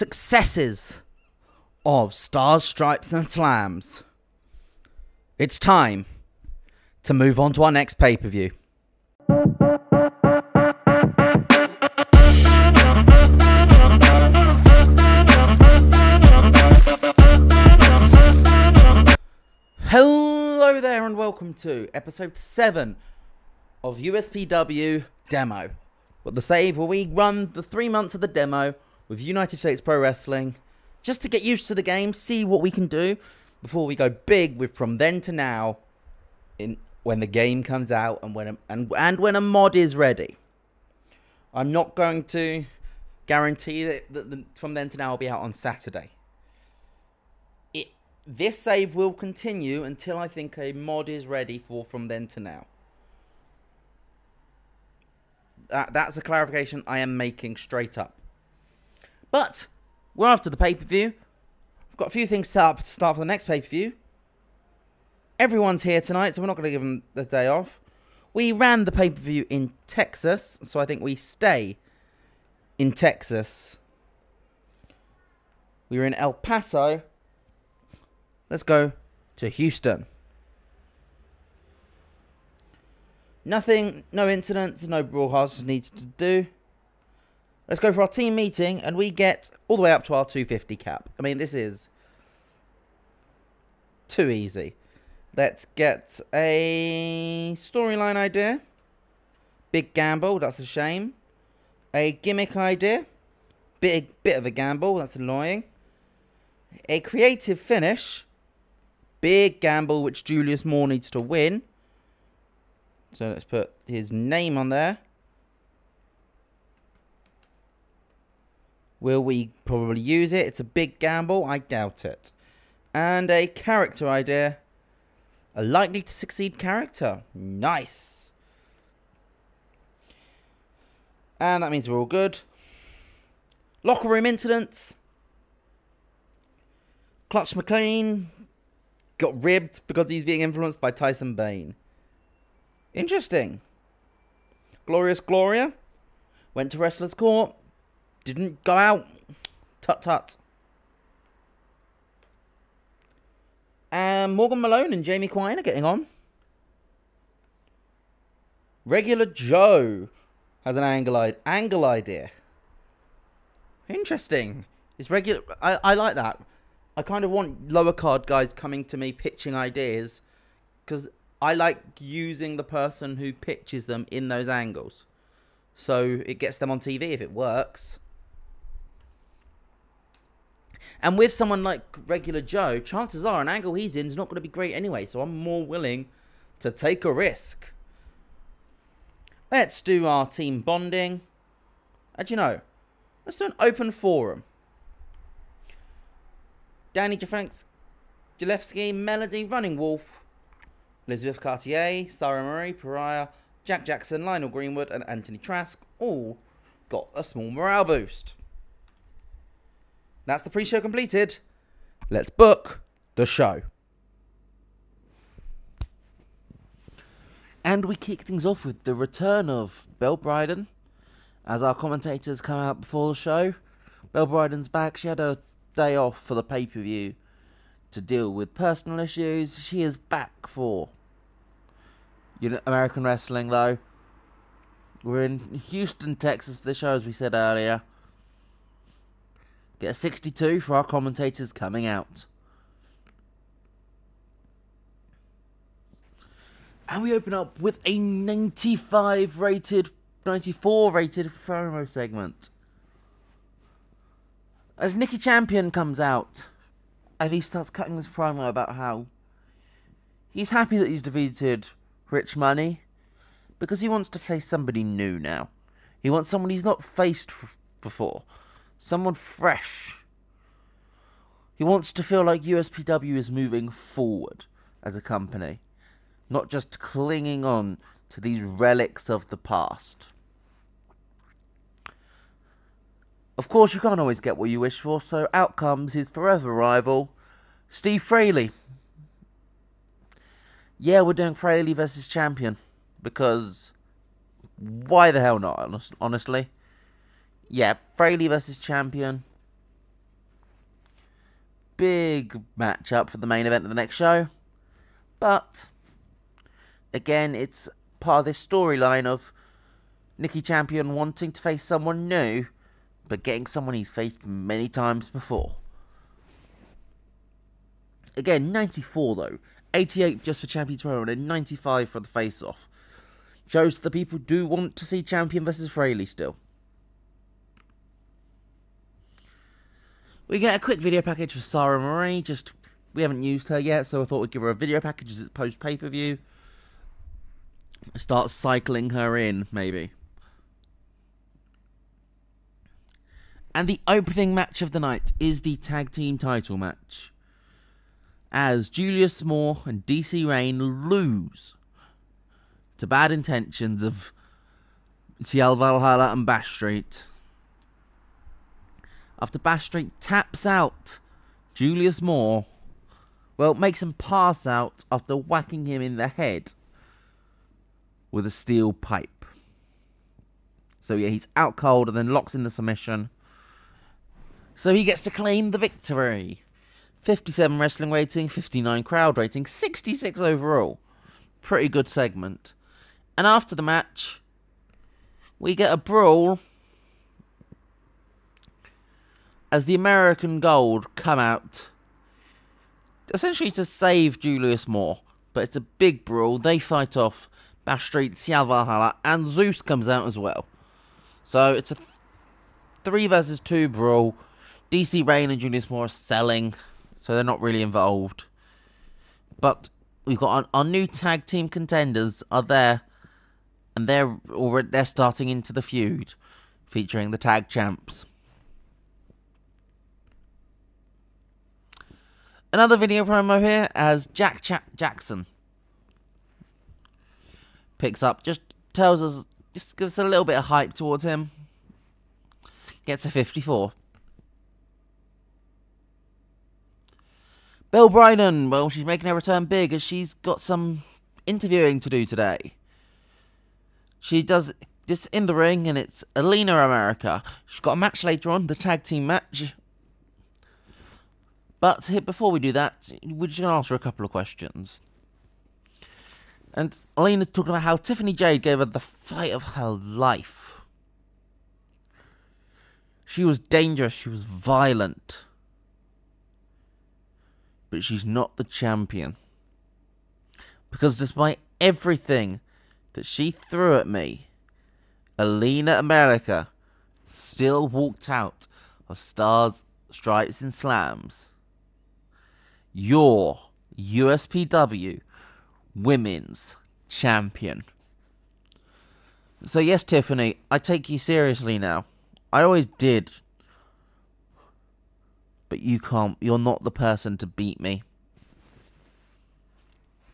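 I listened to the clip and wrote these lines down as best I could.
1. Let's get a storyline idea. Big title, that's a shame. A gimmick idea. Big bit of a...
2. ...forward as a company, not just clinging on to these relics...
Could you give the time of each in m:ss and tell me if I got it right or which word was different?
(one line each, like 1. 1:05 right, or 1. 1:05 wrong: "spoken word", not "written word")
1. 1:35 wrong: "gamble", not "title"
2. 4:33 right.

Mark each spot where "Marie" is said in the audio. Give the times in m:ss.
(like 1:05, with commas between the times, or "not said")
3:22, 5:31.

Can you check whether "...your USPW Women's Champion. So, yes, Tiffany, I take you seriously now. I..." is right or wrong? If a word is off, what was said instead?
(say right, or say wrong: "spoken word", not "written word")
right.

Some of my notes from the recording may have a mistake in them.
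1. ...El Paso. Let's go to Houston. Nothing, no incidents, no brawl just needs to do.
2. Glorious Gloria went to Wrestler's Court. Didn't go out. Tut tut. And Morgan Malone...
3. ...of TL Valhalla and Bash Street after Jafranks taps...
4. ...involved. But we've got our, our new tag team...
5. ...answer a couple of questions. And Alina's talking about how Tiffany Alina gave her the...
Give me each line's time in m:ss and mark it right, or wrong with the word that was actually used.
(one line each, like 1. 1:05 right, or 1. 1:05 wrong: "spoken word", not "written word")
1. 1:16 right
2. 2:24 right
3. 5:53 wrong: "Backstreet", not "Jafranks"
4. 6:47 right
5. 7:33 wrong: "Jade", not "Alina".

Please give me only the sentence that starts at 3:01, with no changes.
And with someone like regular Joe, chances are an angle he's in is not going to be great anyway.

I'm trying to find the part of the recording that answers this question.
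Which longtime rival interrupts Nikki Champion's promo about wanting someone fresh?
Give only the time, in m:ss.
4:47.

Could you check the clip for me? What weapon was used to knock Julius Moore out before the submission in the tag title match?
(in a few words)
steel pipe.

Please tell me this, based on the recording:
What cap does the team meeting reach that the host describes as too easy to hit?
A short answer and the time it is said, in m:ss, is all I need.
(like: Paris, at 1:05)
250, at 1:30.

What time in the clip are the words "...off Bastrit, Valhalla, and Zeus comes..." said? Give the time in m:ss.
6:36.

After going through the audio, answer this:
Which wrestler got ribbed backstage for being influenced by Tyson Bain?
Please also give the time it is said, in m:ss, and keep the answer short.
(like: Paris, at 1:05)
Clutch McLean, at 2:17.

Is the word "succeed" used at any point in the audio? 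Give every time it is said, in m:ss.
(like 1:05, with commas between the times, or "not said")
2:06.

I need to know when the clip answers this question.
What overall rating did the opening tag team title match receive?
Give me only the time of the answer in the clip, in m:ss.
6:19.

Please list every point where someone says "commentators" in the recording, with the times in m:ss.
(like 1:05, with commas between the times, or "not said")
3:41, 4:00.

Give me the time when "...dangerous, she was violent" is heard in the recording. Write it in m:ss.
7:43.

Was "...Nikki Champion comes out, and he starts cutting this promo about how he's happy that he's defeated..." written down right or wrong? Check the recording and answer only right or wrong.
right.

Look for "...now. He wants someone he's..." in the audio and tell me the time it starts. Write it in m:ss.
4:25.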